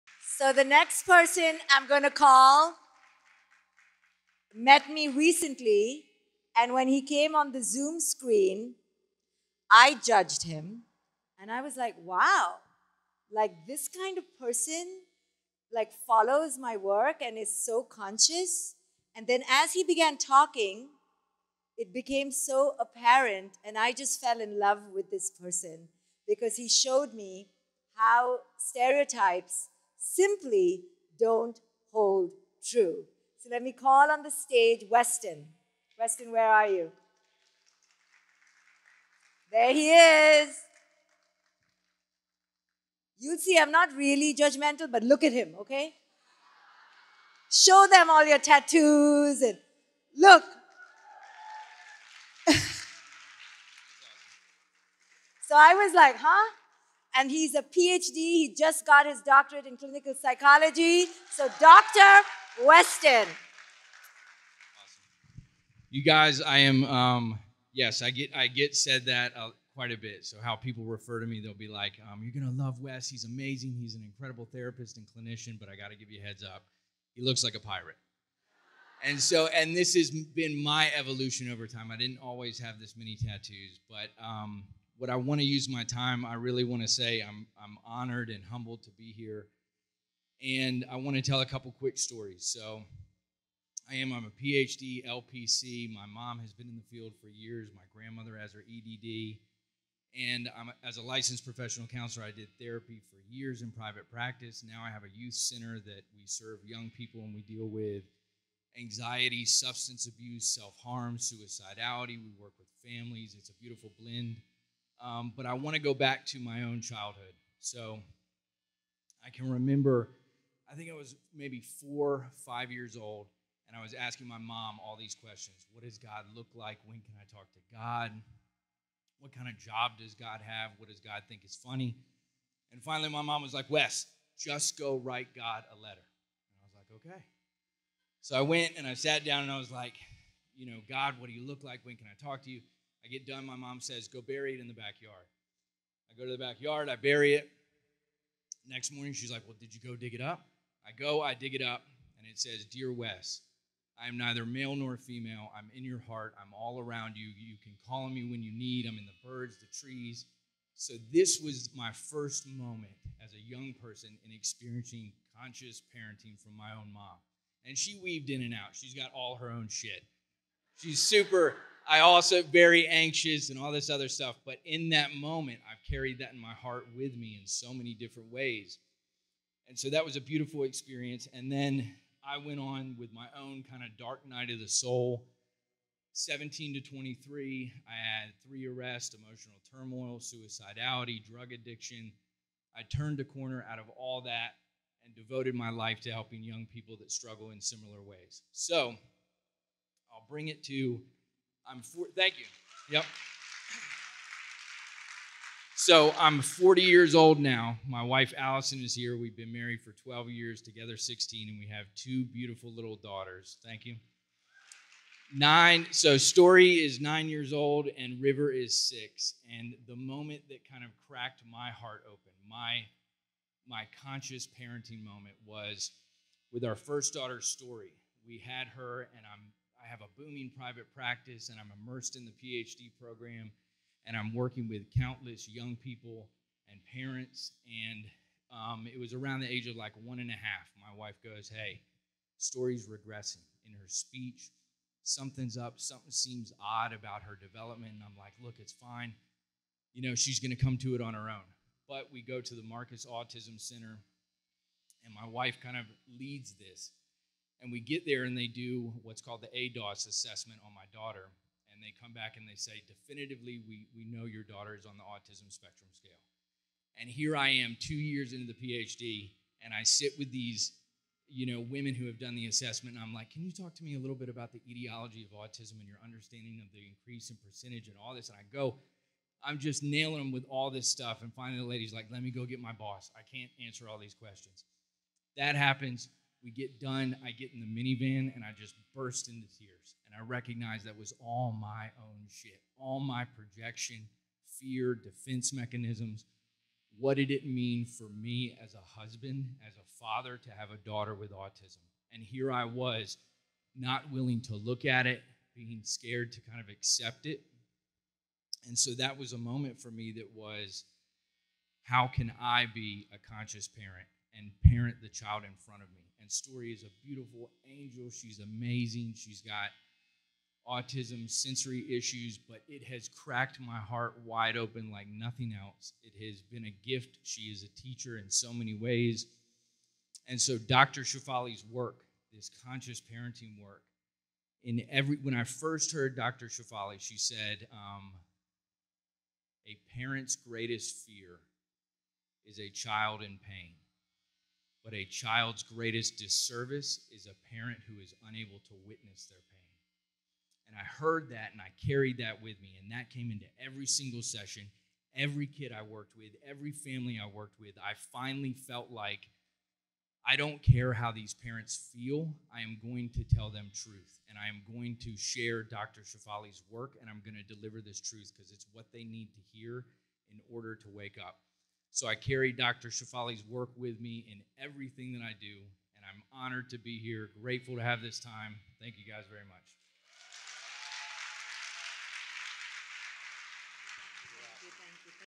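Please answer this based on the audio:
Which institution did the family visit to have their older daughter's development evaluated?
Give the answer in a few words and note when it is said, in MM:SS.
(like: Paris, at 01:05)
Marcus Autism Center, at 04:12.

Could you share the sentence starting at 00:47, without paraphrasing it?
Show them all your tattoos and look.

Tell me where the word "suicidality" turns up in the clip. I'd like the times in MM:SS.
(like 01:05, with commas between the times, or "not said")
01:51, 03:10.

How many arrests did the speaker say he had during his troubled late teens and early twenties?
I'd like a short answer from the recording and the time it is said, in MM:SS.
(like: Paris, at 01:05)
3, at 03:08.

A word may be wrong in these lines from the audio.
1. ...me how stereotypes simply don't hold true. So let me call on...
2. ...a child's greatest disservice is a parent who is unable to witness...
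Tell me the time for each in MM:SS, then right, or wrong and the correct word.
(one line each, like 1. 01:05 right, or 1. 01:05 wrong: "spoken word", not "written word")
1. 00:27 right
2. 05:44 right.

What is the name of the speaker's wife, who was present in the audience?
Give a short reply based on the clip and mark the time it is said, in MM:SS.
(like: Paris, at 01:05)
Allison, at 03:28.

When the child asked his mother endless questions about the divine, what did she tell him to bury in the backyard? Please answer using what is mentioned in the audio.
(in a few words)
A letter.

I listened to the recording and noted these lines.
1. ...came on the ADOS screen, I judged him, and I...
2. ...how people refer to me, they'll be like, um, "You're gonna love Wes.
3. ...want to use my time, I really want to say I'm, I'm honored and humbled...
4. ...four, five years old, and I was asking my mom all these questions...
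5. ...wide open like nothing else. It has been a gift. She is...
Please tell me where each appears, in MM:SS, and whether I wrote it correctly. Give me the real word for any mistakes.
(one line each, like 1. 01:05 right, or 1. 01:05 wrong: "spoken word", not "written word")
1. 00:07 wrong: "Zoom", not "ADOS"
2. 01:10 right
3. 01:25 right
4. 02:01 right
5. 05:24 right.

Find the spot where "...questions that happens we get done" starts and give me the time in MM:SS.
04:44.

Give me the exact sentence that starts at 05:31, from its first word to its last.
Shefali's work, this conscious parenting work, in every when I first heard Dr.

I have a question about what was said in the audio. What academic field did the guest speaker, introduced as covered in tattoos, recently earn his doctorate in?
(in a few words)
Clinical psychology.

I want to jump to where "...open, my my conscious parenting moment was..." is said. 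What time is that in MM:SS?
03:42.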